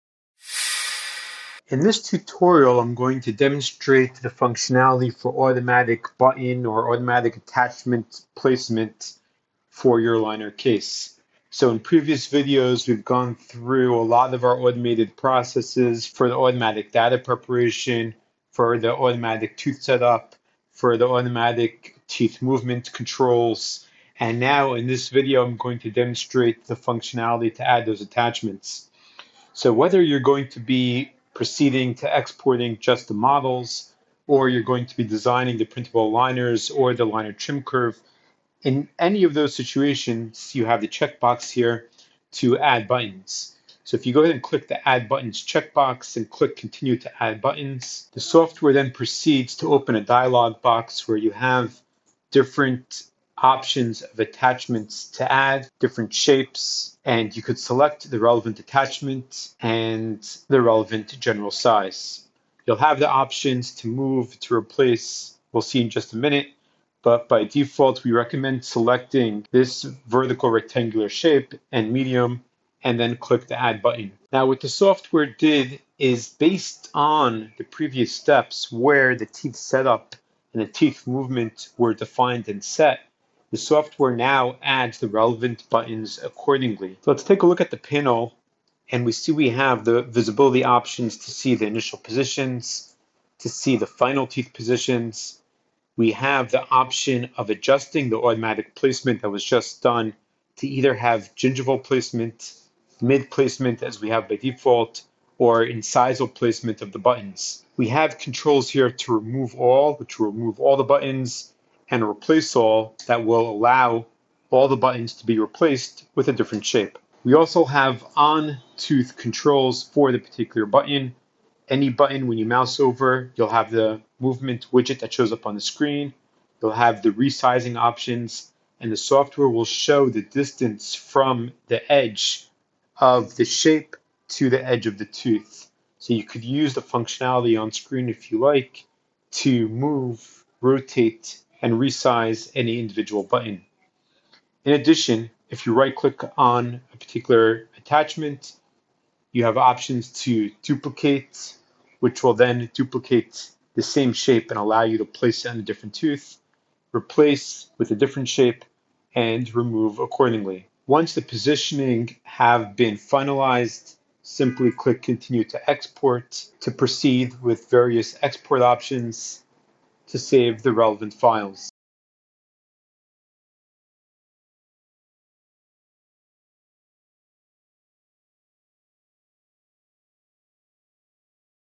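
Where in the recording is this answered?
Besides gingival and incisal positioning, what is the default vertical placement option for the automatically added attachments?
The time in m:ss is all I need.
1:43.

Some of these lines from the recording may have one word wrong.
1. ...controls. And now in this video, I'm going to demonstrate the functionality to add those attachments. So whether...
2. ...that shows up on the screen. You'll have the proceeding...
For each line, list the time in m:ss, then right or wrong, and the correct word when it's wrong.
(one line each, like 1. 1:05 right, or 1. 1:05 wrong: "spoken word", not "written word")
1. 0:22 right
2. 2:04 wrong: "resizing", not "proceeding".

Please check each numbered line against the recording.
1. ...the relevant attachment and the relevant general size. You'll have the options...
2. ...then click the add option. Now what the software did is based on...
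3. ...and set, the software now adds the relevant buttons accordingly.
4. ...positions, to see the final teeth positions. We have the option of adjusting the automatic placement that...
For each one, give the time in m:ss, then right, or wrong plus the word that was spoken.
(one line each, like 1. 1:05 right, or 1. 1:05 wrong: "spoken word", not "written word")
1. 0:58 right
2. 1:12 wrong: "button", not "option"
3. 1:22 right
4. 1:31 right.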